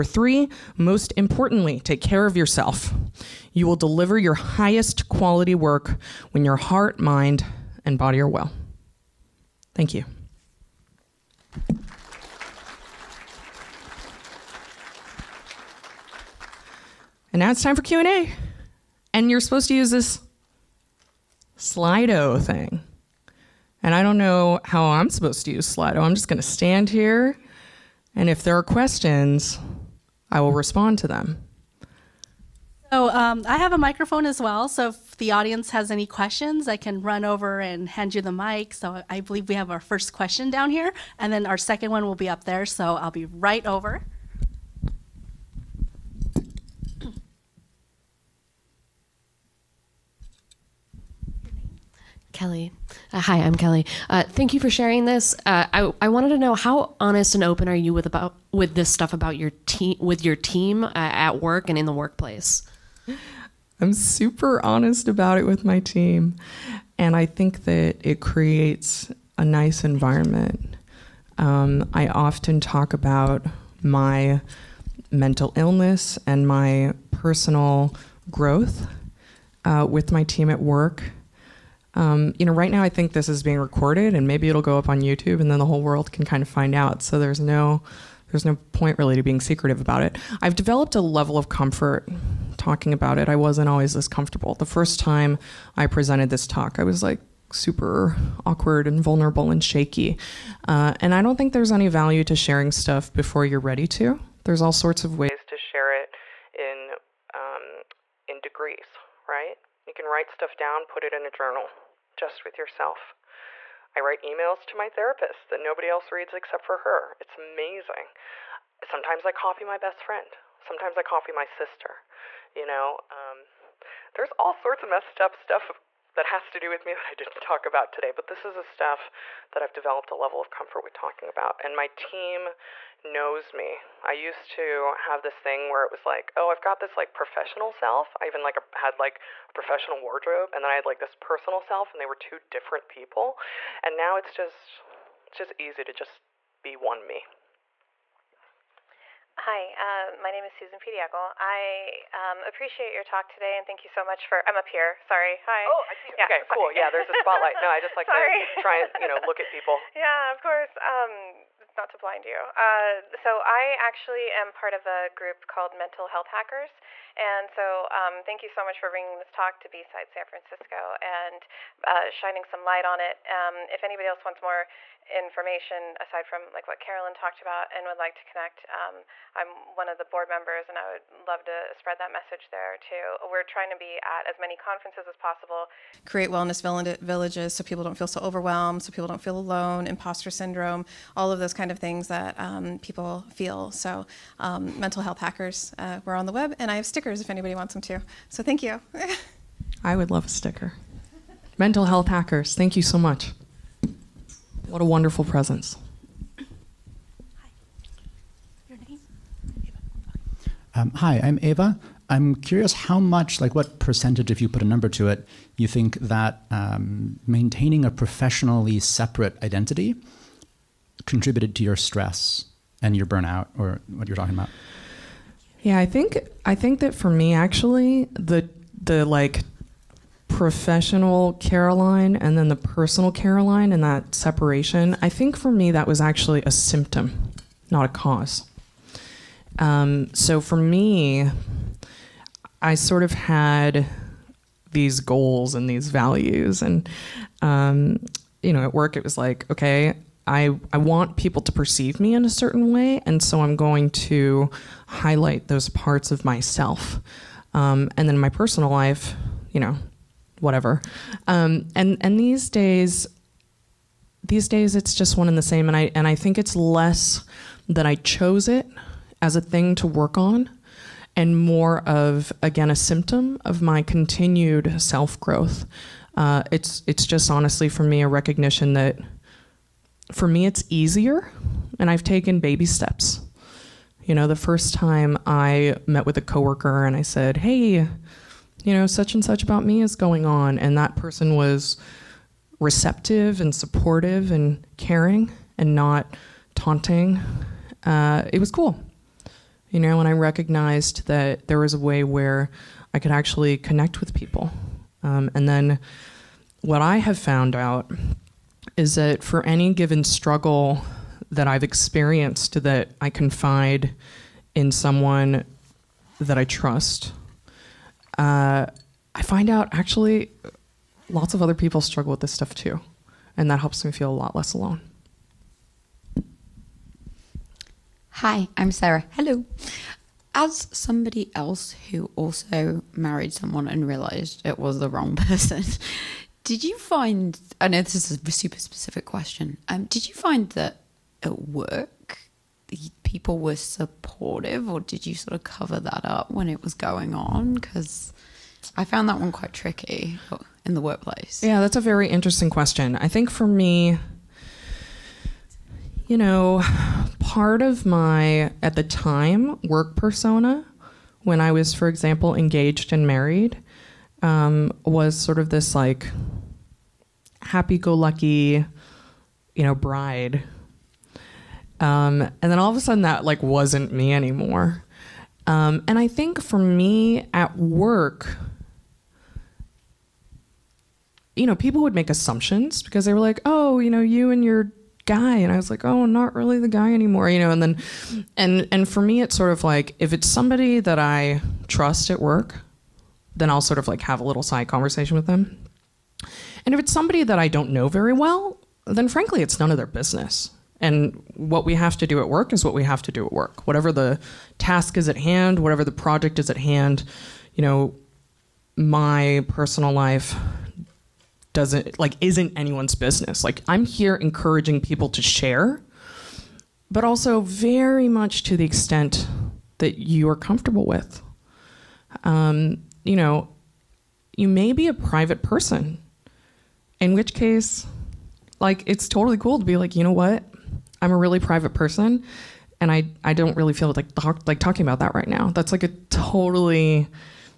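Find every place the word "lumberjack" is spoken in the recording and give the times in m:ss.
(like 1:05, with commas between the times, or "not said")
not said.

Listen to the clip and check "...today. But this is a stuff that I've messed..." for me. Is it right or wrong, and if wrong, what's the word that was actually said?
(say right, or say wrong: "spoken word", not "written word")
wrong: "developed", not "messed".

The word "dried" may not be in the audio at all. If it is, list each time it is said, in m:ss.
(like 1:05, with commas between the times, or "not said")
not said.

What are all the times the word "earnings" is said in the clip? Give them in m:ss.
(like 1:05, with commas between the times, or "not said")
not said.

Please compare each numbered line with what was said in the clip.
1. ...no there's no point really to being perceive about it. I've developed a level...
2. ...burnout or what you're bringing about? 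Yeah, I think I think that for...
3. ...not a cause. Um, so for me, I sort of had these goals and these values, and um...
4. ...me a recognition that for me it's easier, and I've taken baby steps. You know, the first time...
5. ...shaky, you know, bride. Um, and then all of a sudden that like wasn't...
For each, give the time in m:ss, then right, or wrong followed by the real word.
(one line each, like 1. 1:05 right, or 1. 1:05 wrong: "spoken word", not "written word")
1. 1:27 wrong: "secretive", not "perceive"
2. 3:43 wrong: "talking", not "bringing"
3. 3:57 right
4. 4:37 right
5. 6:07 wrong: "lucky", not "shaky".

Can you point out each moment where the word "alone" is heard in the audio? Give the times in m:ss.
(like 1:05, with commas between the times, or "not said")
3:09, 5:24.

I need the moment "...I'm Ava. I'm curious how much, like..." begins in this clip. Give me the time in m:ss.
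3:31.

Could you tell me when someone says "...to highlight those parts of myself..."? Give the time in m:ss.
4:14.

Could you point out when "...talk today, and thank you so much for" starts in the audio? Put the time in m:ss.
2:33.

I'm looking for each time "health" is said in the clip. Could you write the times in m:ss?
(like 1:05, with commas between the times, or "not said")
2:46, 3:15, 3:21.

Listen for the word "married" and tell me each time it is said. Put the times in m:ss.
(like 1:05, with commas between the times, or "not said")
5:32, 6:03.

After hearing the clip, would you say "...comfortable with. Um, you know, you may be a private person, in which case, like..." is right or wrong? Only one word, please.
right.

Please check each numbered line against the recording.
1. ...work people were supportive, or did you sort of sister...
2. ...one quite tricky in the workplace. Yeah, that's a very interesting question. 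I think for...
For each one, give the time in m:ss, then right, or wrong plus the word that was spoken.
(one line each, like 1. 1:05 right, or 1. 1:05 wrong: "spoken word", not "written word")
1. 5:41 wrong: "cover", not "sister"
2. 5:49 right.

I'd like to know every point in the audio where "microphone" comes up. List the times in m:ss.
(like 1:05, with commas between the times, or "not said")
0:33.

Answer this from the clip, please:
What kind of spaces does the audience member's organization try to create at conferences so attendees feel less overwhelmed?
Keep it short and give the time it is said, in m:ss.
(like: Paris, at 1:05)
Wellness villages, at 3:06.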